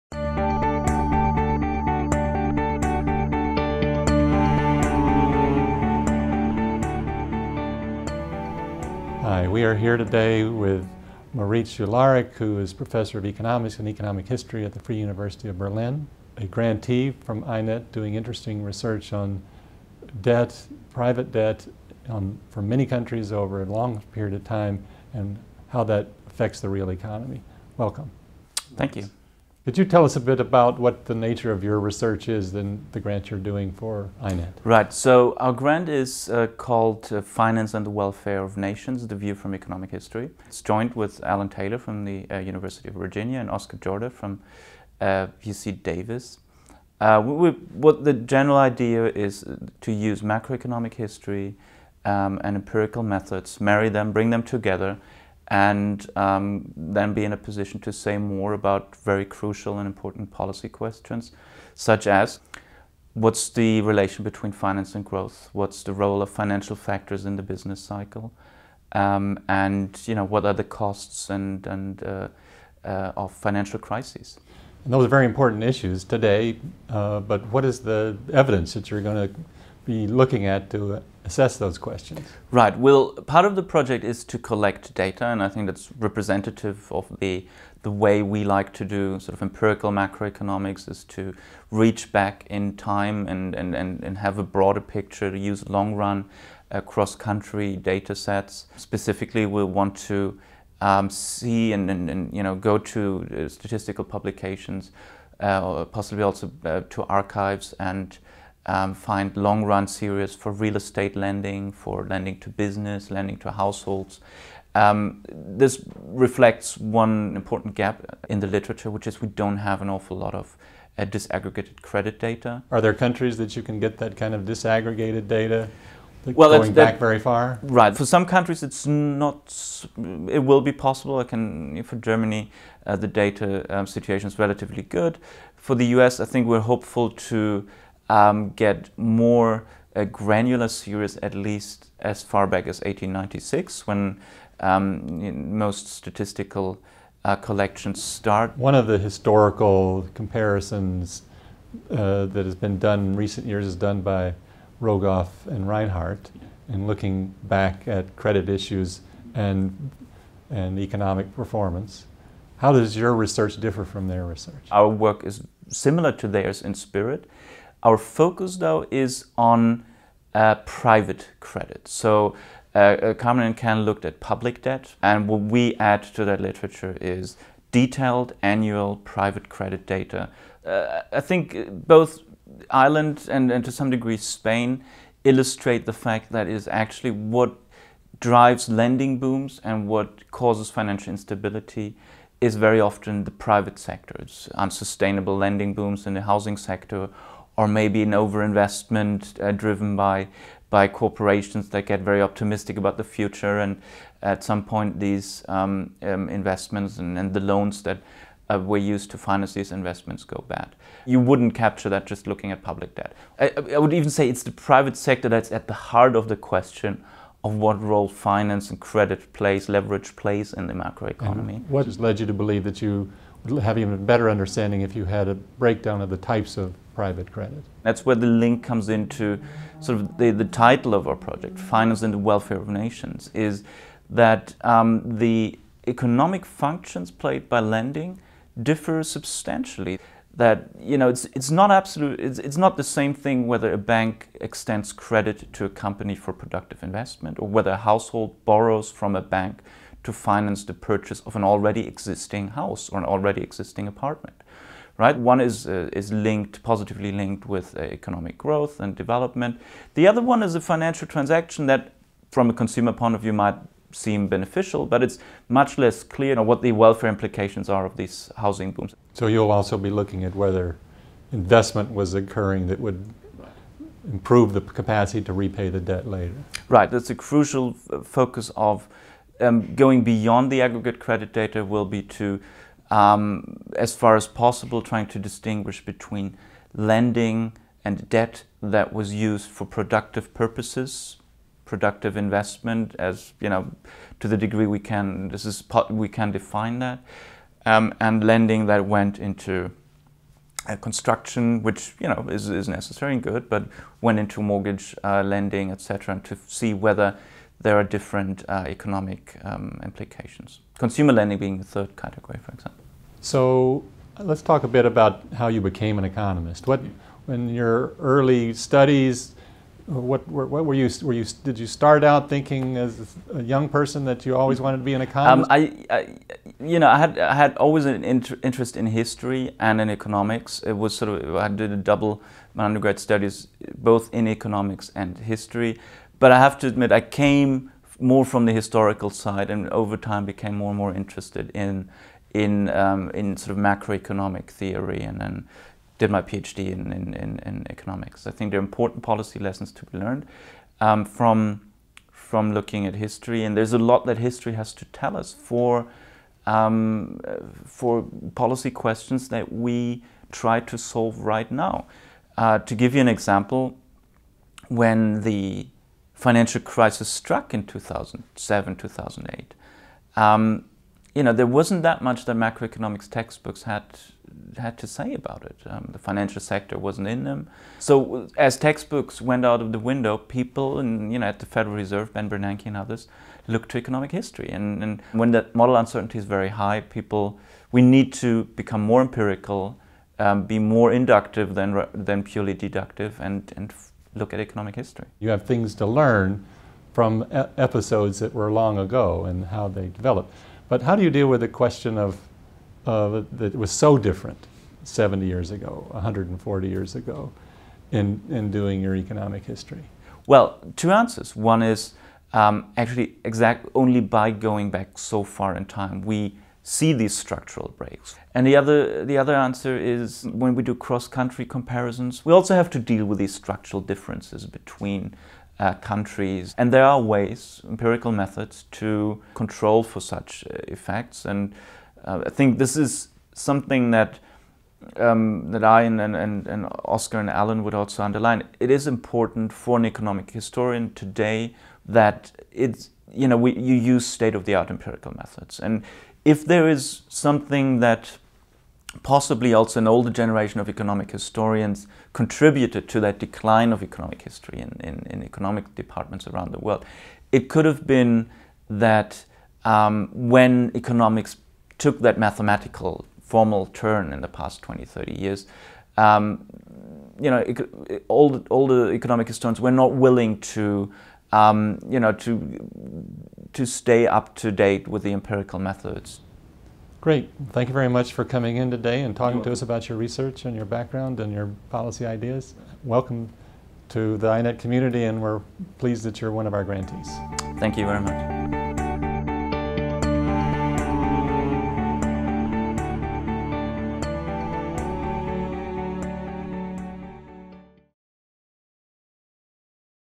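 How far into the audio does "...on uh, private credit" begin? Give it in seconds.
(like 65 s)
169 s.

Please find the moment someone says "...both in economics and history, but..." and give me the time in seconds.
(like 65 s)
333 s.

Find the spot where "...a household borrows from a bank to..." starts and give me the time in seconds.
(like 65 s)
247 s.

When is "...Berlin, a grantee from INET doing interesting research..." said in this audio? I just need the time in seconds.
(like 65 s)
15 s.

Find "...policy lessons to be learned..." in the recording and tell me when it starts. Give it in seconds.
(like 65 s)
349 s.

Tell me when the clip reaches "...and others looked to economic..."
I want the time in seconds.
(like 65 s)
382 s.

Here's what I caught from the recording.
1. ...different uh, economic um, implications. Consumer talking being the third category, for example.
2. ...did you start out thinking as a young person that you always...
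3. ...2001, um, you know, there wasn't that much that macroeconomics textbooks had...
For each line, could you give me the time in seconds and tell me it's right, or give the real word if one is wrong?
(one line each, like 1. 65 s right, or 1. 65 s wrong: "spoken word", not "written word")
1. 307 s wrong: "lending", not "talking"
2. 321 s right
3. 368 s wrong: "2008", not "2001".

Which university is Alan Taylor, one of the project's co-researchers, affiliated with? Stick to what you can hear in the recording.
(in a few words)
University of Virginia.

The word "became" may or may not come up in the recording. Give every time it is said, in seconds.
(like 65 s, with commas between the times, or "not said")
315 s, 340 s.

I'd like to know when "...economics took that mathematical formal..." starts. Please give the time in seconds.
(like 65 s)
460 s.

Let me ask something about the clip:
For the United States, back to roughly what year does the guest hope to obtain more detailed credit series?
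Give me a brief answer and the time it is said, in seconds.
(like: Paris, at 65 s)
1896, at 142 s.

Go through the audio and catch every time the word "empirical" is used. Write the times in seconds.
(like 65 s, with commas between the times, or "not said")
52 s, 89 s, 389 s, 427 s, 444 s, 475 s.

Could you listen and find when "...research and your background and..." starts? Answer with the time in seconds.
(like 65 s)
479 s.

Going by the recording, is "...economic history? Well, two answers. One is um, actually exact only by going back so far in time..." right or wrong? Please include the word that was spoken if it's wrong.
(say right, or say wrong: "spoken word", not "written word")
right.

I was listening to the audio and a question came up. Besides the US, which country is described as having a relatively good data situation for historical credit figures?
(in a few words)
Germany.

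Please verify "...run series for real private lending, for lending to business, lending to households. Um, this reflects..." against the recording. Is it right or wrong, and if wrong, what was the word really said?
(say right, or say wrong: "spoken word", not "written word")
wrong: "estate", not "private".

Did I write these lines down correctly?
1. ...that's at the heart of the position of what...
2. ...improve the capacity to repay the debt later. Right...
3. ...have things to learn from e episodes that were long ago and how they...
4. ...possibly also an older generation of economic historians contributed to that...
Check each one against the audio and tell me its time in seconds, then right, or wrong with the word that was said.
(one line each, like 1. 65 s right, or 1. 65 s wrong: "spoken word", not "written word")
1. 215 s wrong: "question", not "position"
2. 274 s right
3. 395 s right
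4. 449 s right.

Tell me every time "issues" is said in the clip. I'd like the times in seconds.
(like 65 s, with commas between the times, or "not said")
75 s, 158 s.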